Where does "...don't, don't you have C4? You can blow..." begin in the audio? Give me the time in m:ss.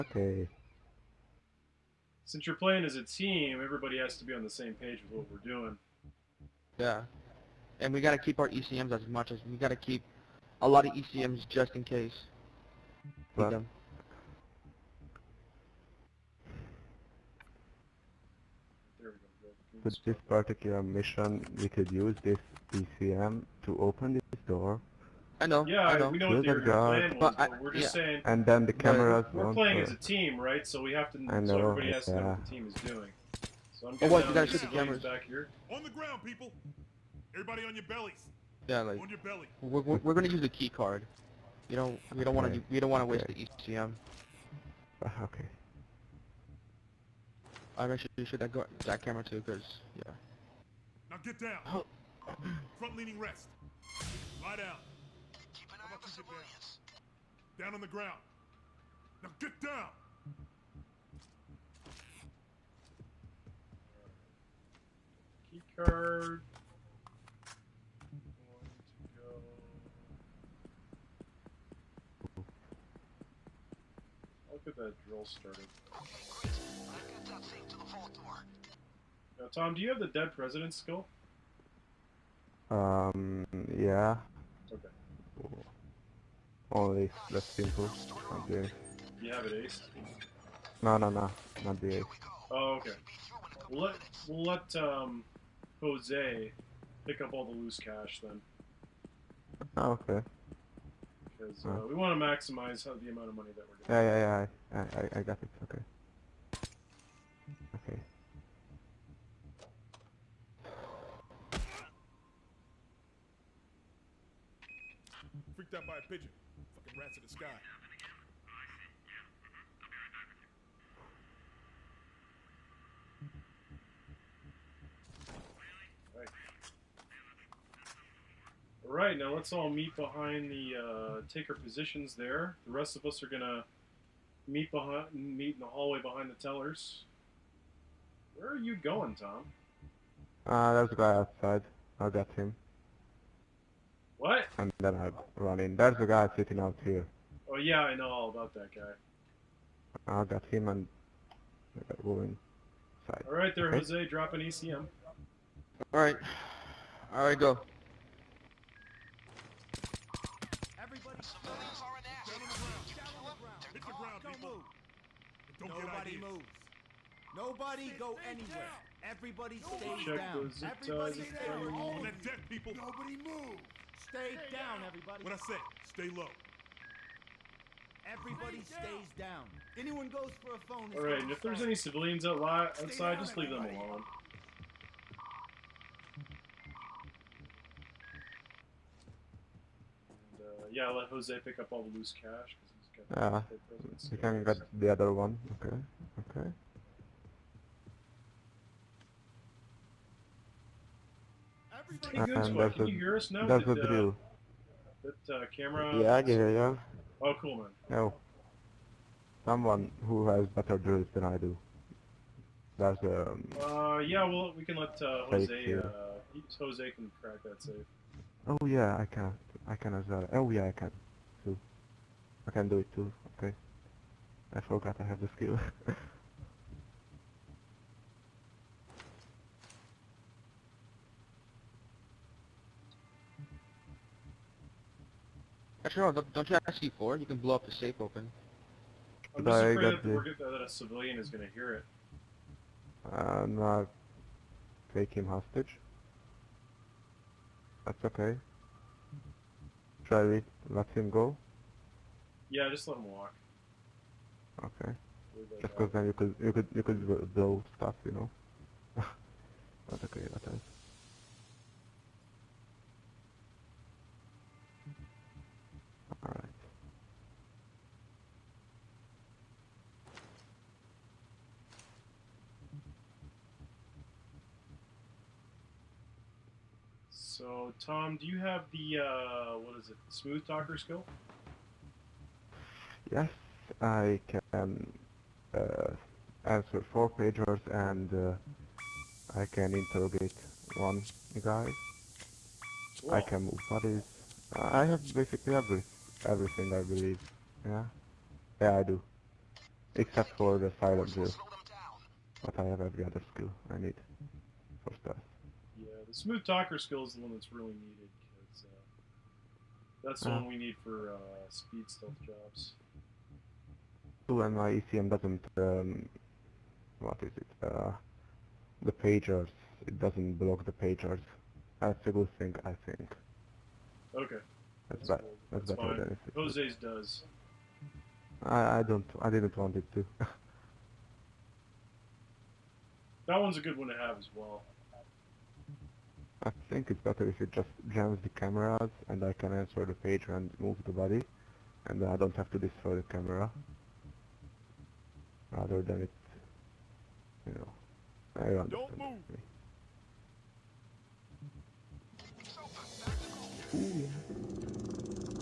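3:56.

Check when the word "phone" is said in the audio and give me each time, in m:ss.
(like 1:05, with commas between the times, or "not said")
3:00.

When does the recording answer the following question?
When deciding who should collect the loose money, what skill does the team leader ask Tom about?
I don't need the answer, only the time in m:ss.
1:20.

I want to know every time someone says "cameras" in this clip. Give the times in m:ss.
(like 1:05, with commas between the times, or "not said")
0:28, 0:34, 0:49, 3:25, 5:38, 5:43.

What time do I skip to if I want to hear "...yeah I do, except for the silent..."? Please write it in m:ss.
4:58.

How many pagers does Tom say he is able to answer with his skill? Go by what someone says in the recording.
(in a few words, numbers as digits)
4.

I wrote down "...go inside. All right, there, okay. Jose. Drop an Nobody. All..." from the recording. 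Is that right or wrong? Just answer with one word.
wrong.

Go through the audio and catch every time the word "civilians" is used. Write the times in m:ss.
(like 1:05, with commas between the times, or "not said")
0:56, 3:01, 4:00.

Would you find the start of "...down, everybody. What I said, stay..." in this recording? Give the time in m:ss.
2:54.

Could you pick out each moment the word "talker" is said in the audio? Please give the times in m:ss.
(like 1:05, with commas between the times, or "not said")
4:40, 5:06.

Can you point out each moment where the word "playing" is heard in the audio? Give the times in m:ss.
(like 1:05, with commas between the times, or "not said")
0:02, 0:29.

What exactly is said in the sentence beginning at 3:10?
Uh, yeah, i yeah, let Jose pick up all the loose cash.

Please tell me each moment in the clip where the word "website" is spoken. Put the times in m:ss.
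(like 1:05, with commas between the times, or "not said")
not said.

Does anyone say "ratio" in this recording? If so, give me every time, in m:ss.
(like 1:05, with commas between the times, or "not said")
not said.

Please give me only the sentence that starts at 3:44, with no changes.
I forgot I have the skill.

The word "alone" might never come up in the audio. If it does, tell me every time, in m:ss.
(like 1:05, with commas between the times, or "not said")
3:03.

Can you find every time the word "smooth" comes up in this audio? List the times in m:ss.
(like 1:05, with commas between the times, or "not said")
4:40, 5:06.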